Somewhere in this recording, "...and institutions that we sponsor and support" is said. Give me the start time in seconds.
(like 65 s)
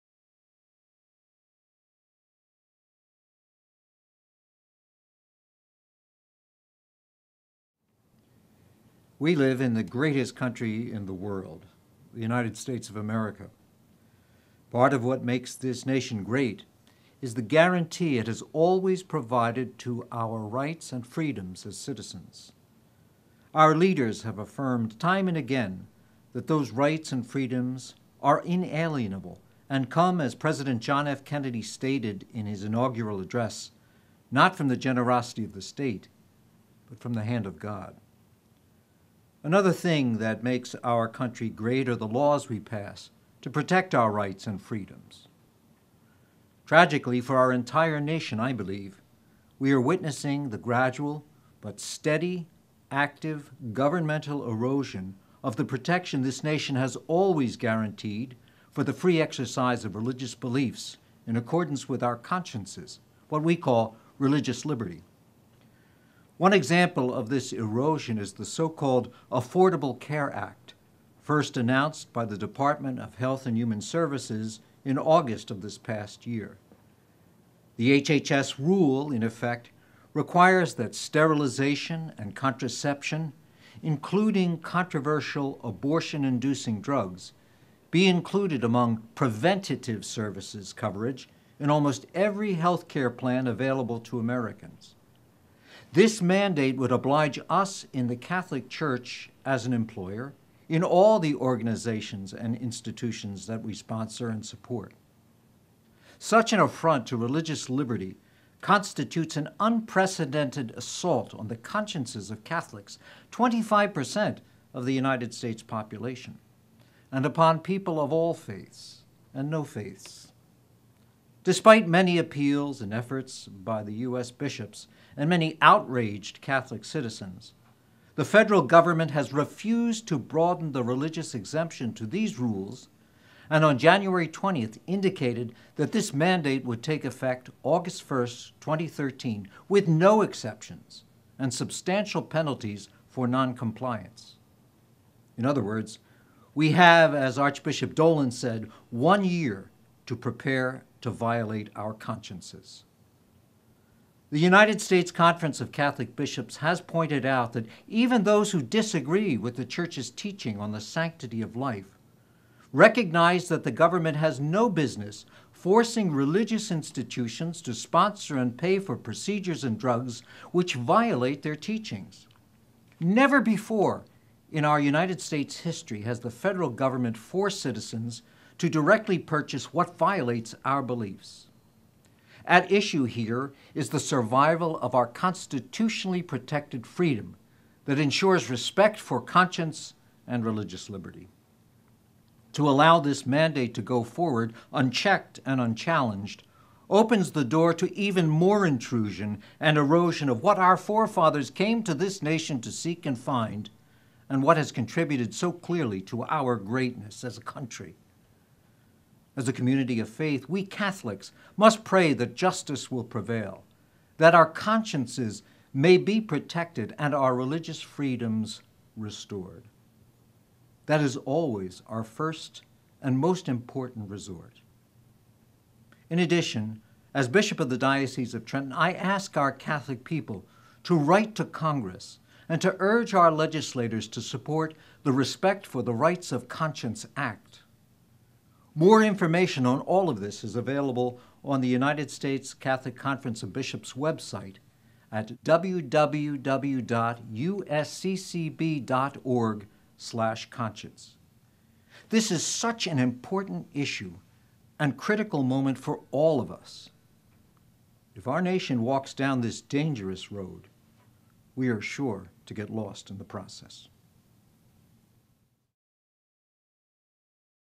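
102 s.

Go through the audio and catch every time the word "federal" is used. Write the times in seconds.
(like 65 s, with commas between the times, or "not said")
128 s, 176 s.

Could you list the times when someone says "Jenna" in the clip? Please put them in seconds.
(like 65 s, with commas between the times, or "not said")
not said.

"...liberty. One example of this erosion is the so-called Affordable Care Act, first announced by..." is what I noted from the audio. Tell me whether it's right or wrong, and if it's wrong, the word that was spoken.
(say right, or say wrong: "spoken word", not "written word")
right.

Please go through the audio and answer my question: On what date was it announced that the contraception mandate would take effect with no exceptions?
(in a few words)
January 20th.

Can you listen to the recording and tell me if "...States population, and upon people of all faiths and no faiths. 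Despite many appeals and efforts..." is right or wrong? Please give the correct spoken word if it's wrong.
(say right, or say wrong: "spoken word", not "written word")
right.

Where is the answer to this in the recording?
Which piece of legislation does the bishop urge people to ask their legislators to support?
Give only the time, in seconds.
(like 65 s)
235 s.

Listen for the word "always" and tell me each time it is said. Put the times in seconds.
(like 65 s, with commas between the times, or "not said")
18 s, 57 s, 221 s.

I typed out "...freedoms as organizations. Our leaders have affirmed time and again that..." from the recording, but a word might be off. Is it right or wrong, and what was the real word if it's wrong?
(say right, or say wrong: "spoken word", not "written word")
wrong: "citizens", not "organizations".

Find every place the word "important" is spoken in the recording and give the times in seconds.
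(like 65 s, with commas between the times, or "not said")
223 s, 252 s.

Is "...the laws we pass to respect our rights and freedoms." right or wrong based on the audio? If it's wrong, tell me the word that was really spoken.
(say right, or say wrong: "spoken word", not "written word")
wrong: "protect", not "respect".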